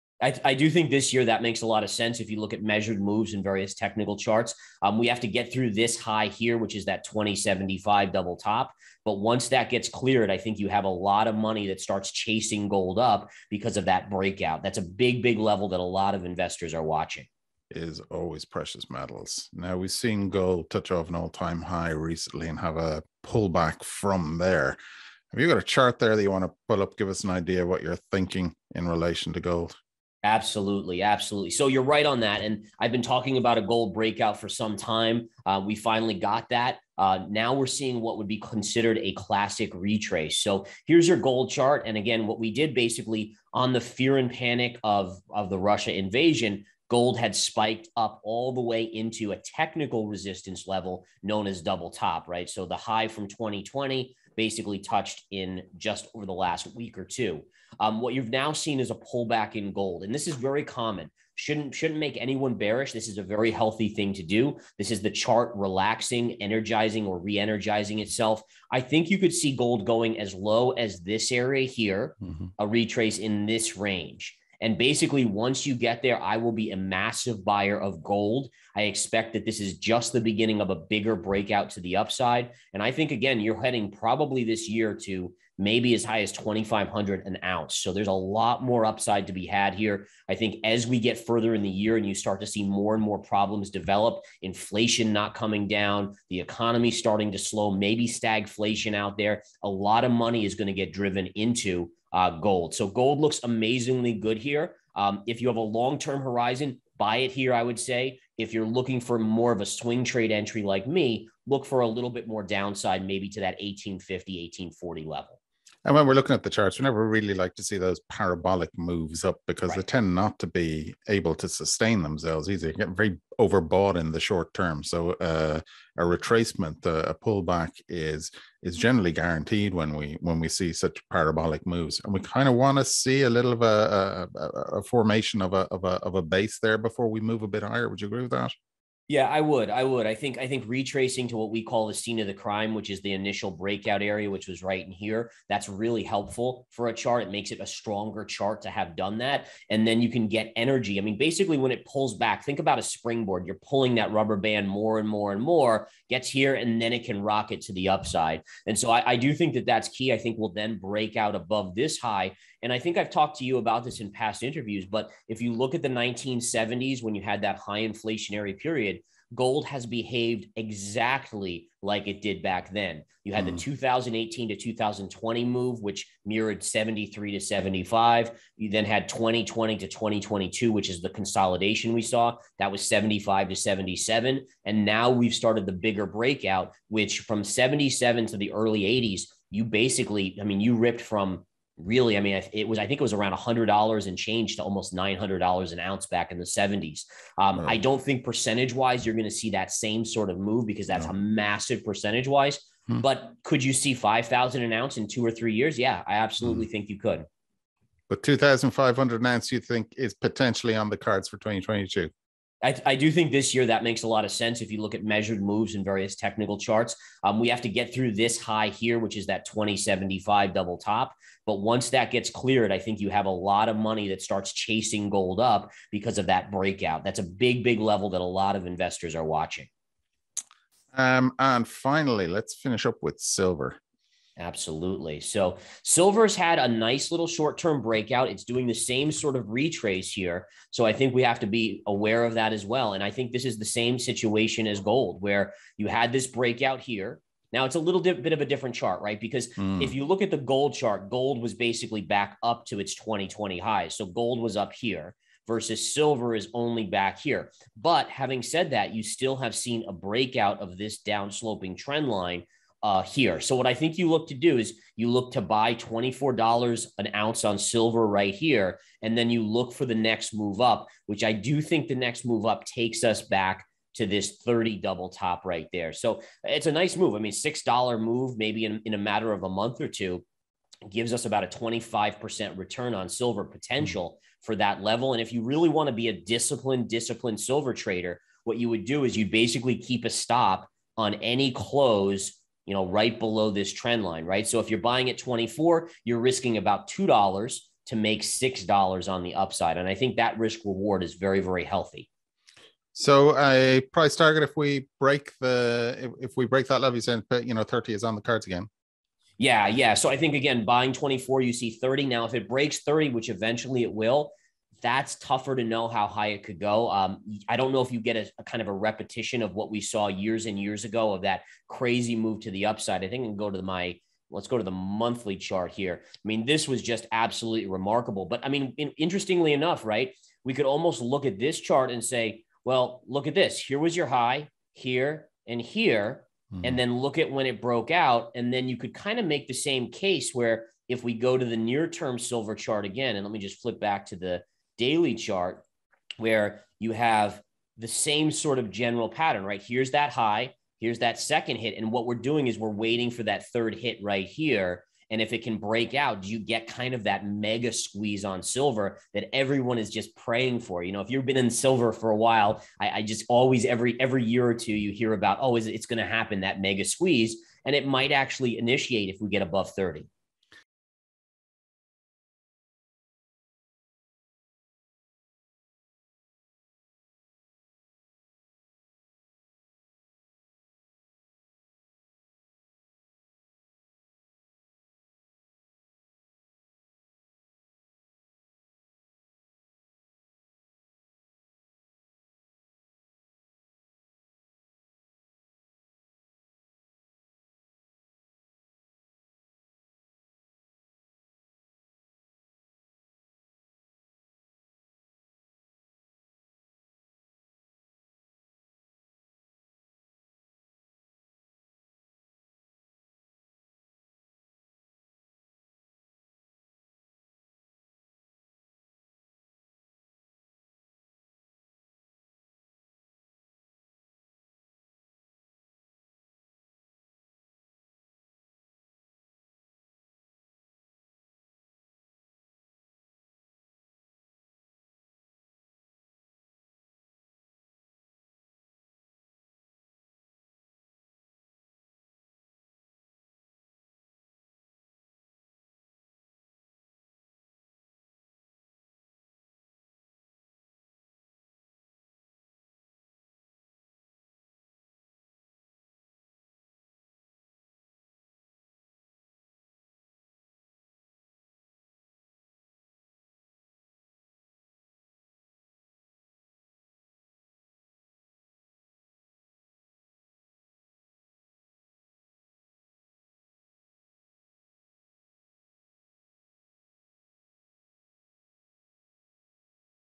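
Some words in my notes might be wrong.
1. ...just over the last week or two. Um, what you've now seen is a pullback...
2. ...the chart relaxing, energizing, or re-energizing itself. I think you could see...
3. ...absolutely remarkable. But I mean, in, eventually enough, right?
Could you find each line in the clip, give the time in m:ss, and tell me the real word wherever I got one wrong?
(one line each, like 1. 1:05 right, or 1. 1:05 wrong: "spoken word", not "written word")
1. 0:55 right
2. 1:05 right
3. 5:27 wrong: "interestingly", not "eventually".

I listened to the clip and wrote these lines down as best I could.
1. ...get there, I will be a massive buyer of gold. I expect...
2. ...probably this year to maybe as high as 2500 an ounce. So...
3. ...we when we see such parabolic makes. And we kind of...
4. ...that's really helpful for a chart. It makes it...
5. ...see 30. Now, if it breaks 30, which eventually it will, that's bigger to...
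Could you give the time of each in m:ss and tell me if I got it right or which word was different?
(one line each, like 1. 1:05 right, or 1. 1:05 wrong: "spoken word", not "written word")
1. 1:15 right
2. 1:23 right
3. 2:09 wrong: "moves", not "makes"
4. 2:25 right
5. 5:11 wrong: "tougher", not "bigger".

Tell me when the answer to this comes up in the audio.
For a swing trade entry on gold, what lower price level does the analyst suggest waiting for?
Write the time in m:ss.
1:54.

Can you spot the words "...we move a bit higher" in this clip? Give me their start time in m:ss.
2:17.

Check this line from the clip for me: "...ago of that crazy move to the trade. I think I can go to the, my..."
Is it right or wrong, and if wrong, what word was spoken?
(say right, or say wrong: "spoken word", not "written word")
wrong: "upside", not "trade".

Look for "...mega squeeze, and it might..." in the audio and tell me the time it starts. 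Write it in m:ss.
6:06.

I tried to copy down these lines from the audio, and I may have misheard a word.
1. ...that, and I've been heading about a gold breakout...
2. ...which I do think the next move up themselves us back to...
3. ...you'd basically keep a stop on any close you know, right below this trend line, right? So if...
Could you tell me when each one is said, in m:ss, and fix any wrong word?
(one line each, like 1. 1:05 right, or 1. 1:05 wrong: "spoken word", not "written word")
1. 0:32 wrong: "talking", not "heading"
2. 4:31 wrong: "takes", not "themselves"
3. 4:49 right.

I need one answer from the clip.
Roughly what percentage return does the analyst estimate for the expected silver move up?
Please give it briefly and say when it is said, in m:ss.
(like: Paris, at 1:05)
25%, at 4:41.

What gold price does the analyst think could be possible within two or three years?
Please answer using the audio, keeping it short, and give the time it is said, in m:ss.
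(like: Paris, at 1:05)
5,000 an ounce, at 3:23.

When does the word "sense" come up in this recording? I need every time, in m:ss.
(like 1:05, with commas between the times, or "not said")
0:01, 3:34.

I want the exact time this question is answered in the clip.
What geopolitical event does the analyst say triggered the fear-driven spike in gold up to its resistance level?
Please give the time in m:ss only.
0:45.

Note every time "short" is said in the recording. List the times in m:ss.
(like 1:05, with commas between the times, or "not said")
2:04, 3:57.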